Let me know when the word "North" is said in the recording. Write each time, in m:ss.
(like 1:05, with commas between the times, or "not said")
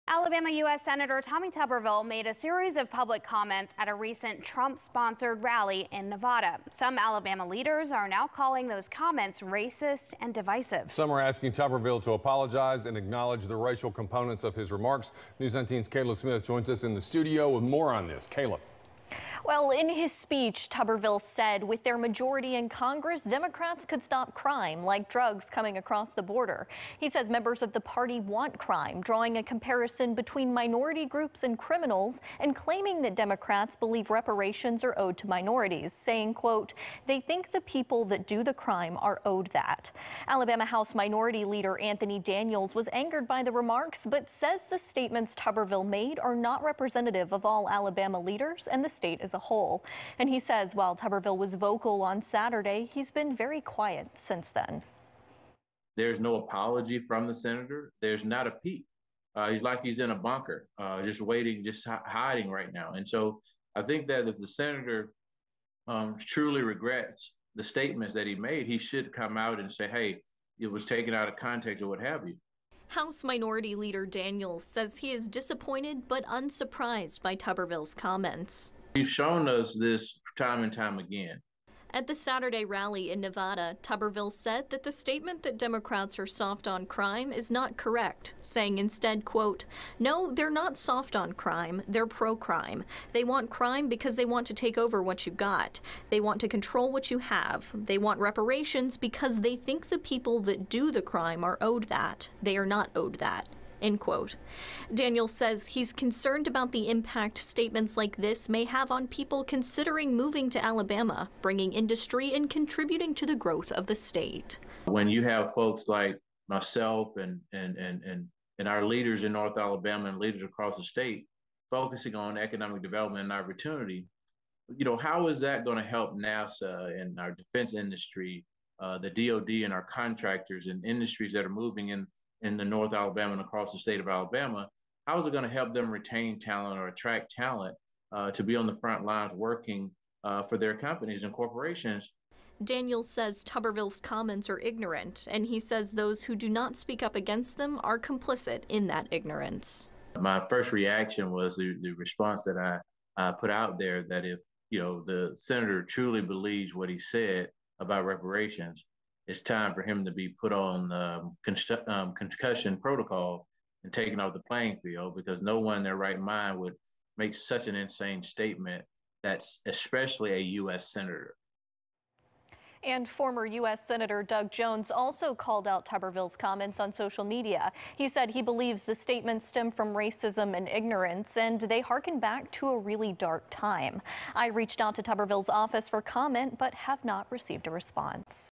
1:59, 2:12.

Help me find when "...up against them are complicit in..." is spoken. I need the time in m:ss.
2:27.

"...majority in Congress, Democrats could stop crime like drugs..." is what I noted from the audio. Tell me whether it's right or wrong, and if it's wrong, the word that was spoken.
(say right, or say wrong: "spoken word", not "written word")
right.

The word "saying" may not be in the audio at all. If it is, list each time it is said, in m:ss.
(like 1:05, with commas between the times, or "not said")
0:35, 1:28.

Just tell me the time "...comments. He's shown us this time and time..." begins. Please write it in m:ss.
1:17.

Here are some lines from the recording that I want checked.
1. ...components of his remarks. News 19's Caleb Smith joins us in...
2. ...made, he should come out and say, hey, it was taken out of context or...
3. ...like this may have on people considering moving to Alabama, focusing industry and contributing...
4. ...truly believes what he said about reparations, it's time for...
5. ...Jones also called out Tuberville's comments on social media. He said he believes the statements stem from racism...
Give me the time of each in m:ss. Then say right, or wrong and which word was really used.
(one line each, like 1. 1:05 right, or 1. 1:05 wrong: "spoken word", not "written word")
1. 0:13 right
2. 1:08 right
3. 1:47 wrong: "bringing", not "focusing"
4. 2:35 right
5. 2:54 right.